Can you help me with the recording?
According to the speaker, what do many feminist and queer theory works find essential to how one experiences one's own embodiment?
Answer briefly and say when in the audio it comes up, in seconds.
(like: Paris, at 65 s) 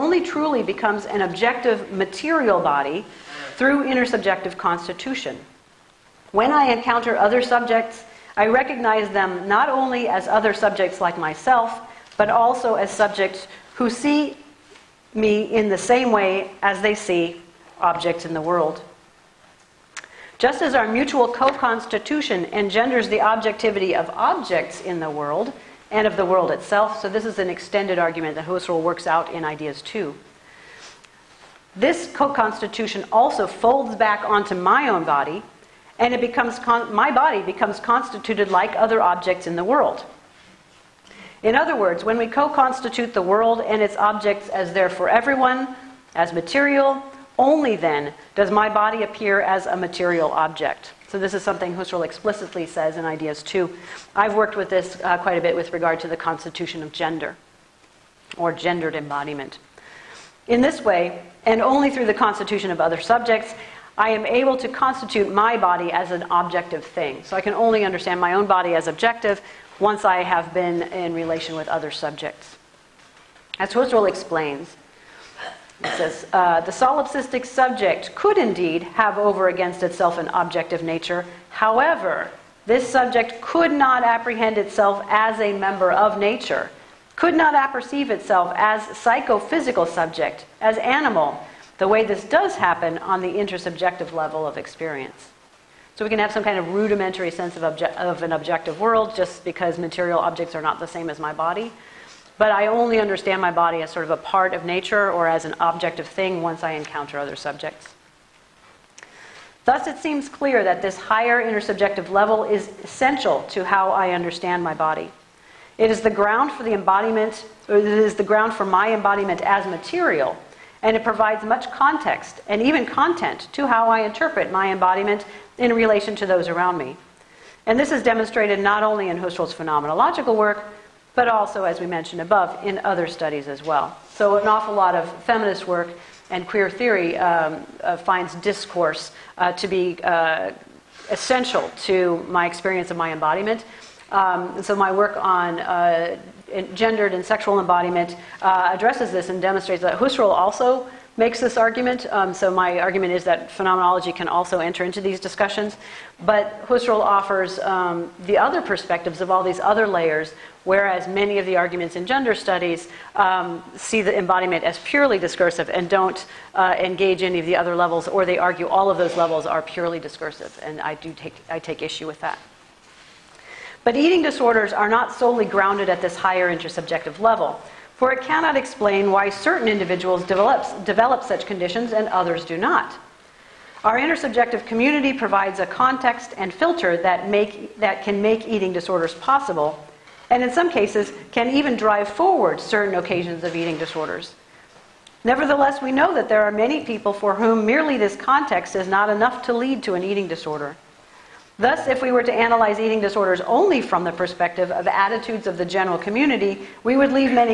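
discourse, at 138 s.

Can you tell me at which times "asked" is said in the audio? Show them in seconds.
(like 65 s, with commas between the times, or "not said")
not said.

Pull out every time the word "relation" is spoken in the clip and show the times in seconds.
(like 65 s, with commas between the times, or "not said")
71 s, 125 s.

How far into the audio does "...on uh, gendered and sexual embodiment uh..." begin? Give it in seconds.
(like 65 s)
145 s.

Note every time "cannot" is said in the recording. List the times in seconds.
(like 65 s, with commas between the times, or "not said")
178 s.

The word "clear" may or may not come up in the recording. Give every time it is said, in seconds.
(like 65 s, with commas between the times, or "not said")
110 s.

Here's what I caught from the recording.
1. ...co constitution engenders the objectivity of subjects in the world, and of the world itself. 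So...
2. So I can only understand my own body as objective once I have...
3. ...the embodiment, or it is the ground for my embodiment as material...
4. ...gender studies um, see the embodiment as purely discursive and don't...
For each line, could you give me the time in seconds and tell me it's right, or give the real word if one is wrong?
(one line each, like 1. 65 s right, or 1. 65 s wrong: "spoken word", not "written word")
1. 21 s wrong: "objects", not "subjects"
2. 67 s right
3. 116 s right
4. 162 s right.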